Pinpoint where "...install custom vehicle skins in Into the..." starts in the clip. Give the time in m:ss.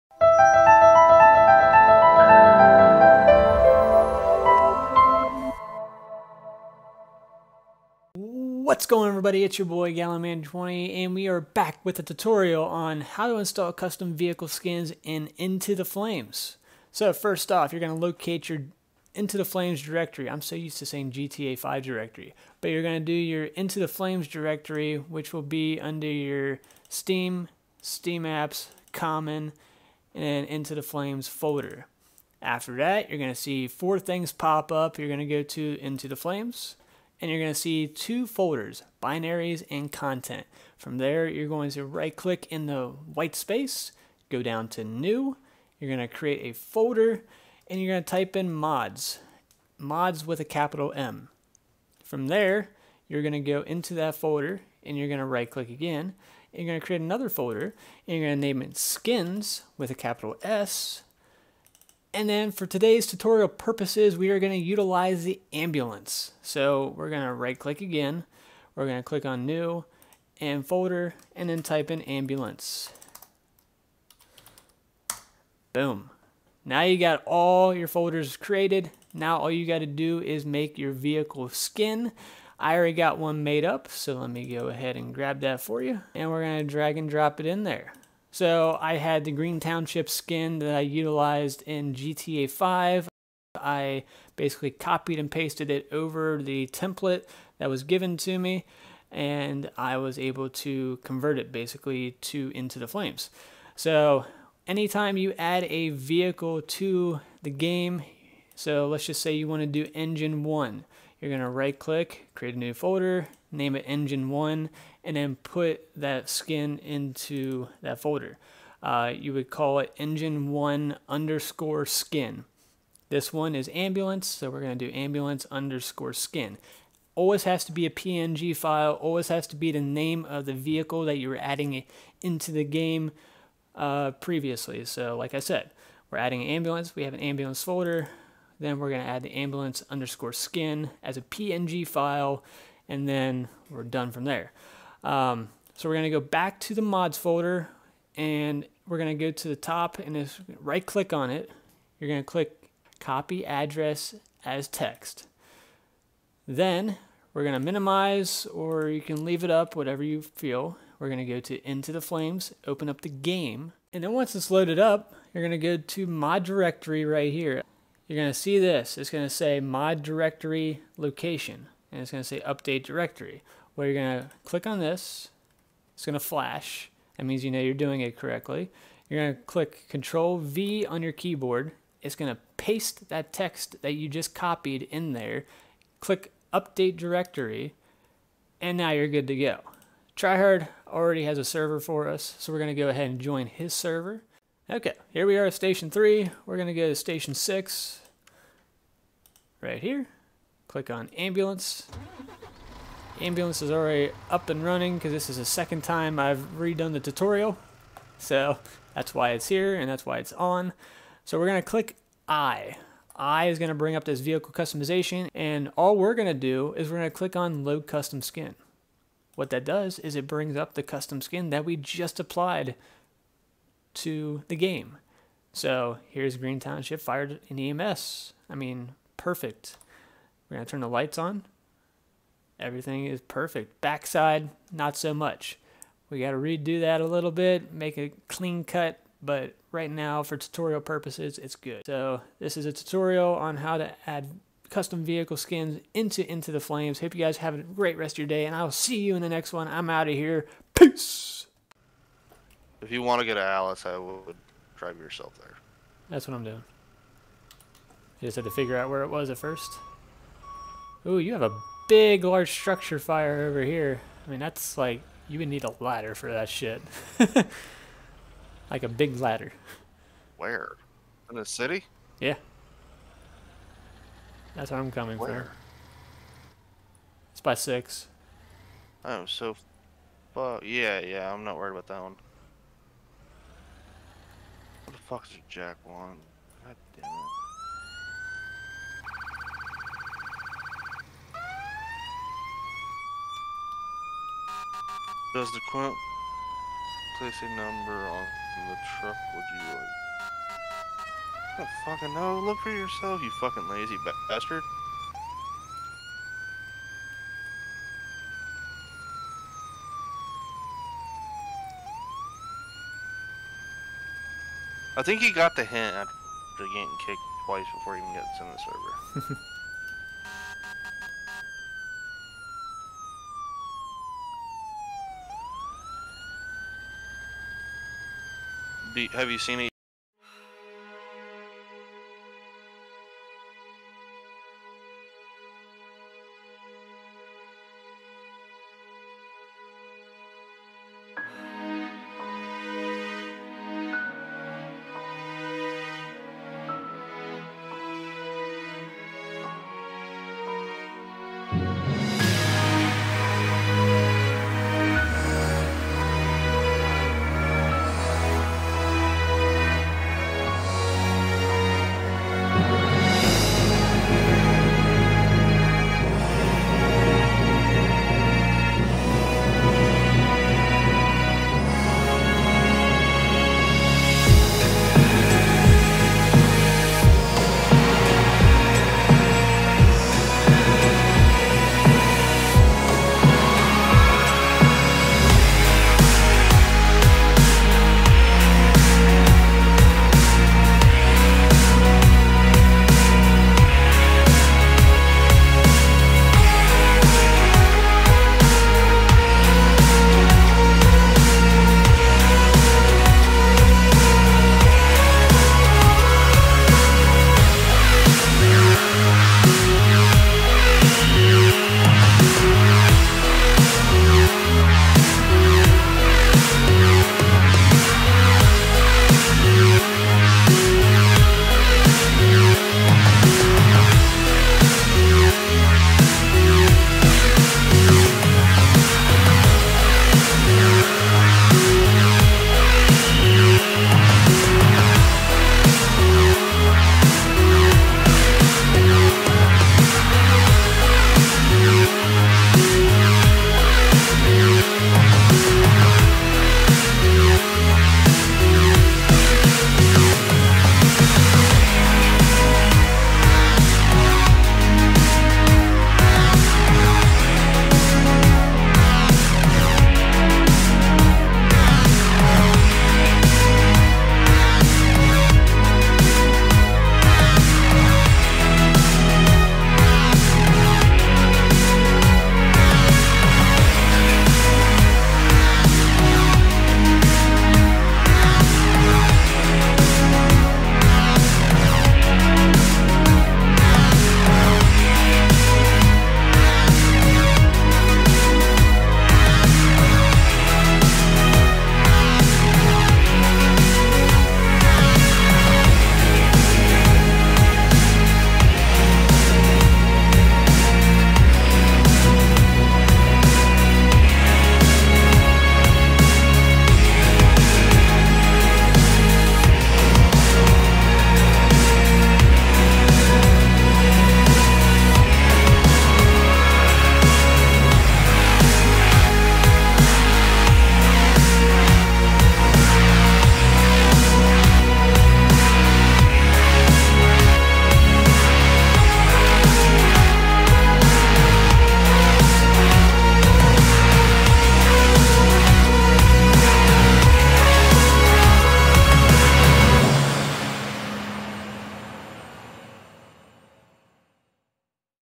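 0:13.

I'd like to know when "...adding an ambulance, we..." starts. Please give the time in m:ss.
2:16.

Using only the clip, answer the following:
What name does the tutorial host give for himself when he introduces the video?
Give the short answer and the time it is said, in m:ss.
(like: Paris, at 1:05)
gallonman 20, at 0:09.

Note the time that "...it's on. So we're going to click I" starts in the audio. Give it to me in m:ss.
3:30.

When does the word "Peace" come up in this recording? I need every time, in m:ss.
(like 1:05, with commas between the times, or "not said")
4:10.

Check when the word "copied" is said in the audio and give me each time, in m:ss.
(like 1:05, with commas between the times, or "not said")
1:34, 3:04.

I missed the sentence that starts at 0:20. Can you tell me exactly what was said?
I'm so used to saying GTA 5 directory.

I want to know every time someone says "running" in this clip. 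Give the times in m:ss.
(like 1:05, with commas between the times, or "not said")
3:24.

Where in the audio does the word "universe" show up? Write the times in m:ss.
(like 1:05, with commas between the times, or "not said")
not said.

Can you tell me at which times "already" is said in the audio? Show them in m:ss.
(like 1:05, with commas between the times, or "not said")
1:22, 3:10, 3:23.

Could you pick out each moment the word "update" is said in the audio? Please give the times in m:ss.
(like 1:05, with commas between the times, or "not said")
2:52, 3:06.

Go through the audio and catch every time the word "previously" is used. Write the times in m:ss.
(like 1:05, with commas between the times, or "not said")
2:14.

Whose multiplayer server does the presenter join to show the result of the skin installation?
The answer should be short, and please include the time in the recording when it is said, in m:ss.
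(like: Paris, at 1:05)
Tryhard, at 3:10.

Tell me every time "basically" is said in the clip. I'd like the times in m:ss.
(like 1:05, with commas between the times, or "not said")
1:34, 1:41.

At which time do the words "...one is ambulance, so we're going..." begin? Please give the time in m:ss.
2:03.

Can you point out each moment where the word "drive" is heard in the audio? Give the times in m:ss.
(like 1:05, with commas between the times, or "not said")
4:14.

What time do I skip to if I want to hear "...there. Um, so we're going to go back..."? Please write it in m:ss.
2:24.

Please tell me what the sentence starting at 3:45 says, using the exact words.
So here's Green Township Fire EMS.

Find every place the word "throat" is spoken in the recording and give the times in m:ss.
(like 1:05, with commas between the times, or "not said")
not said.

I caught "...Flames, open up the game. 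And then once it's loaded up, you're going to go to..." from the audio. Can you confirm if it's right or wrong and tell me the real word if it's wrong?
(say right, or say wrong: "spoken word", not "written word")
right.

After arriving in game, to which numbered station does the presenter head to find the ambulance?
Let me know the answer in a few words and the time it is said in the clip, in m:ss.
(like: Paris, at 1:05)
6, at 3:16.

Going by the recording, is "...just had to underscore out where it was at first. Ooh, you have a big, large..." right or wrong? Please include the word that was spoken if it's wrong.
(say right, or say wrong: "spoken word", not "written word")
wrong: "figure", not "underscore".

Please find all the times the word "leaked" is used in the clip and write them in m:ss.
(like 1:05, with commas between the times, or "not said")
not said.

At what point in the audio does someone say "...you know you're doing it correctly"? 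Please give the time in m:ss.
2:57.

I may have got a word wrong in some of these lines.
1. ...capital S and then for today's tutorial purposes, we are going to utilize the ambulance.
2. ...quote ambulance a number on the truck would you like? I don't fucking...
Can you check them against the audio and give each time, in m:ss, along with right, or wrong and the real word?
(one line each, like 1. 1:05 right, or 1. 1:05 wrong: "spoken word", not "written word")
1. 0:59 right
2. 4:55 wrong: "place", not "ambulance".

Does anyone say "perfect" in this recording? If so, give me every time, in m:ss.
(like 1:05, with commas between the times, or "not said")
3:49, 3:53.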